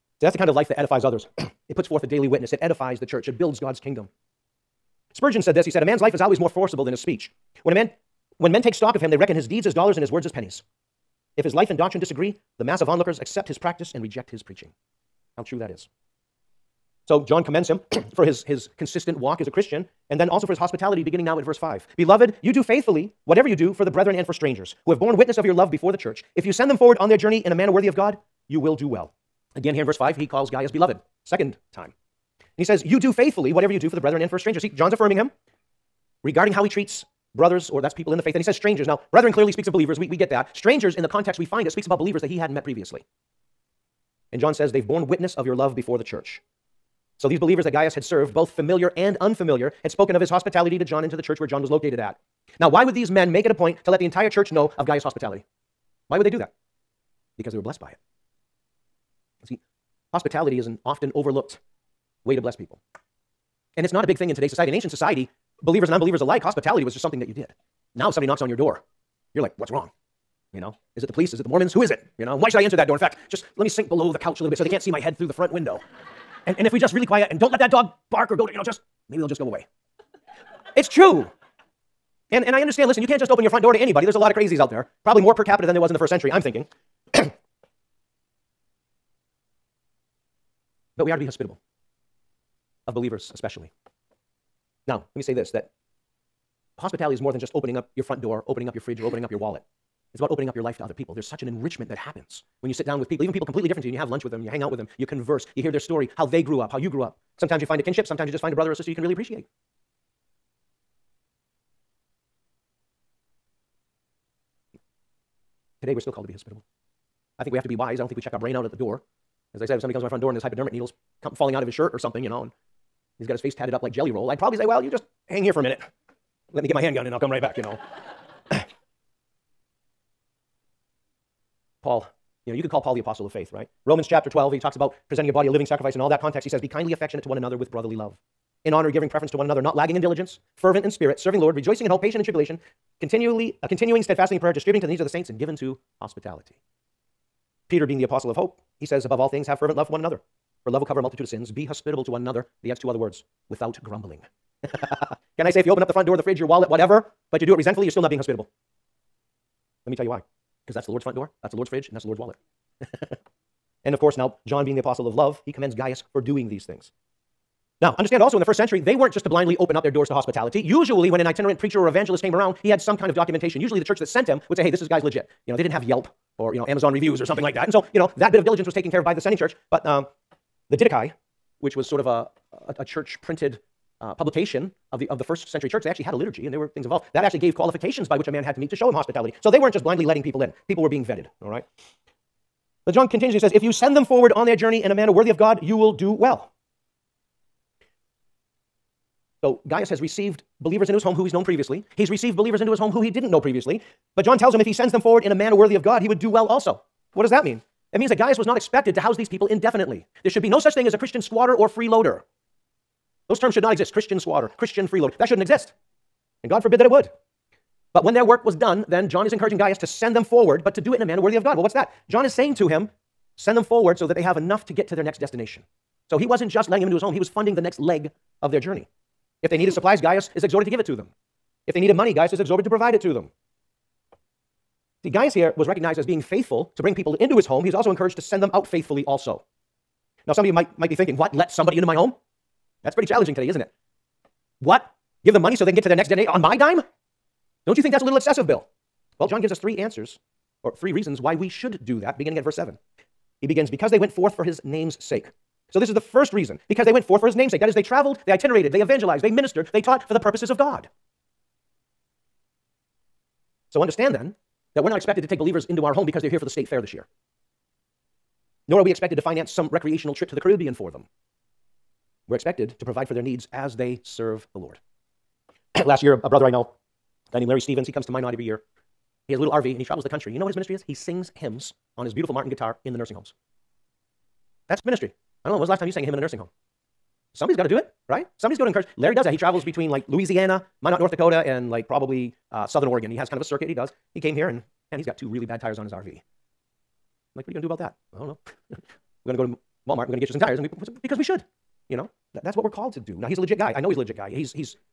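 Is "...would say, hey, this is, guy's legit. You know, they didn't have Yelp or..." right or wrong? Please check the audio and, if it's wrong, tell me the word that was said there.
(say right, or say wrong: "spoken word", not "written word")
right.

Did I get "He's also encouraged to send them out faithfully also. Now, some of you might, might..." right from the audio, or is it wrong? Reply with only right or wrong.
right.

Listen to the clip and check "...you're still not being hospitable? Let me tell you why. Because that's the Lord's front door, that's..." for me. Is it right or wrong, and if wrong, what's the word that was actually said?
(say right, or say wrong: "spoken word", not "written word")
right.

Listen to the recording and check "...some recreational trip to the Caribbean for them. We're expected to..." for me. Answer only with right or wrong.
right.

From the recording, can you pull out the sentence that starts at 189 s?
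So they weren't just blindly letting people in, people were being vetted, all right?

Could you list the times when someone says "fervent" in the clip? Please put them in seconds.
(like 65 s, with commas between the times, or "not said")
140 s, 149 s.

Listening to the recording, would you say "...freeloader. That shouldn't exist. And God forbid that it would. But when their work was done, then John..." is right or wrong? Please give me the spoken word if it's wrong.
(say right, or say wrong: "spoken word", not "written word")
right.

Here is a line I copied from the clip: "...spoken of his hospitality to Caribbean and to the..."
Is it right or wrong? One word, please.
wrong.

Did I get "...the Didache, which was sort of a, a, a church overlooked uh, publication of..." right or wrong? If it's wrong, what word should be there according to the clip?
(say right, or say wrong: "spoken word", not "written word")
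wrong: "printed", not "overlooked".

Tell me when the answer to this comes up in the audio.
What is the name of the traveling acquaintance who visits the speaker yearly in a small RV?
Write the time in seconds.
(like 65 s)
277 s.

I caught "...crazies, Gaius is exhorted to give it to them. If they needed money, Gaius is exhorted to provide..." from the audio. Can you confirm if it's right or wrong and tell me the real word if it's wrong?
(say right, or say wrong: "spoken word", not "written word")
wrong: "supplies", not "crazies".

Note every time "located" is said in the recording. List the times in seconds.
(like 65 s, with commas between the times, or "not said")
51 s.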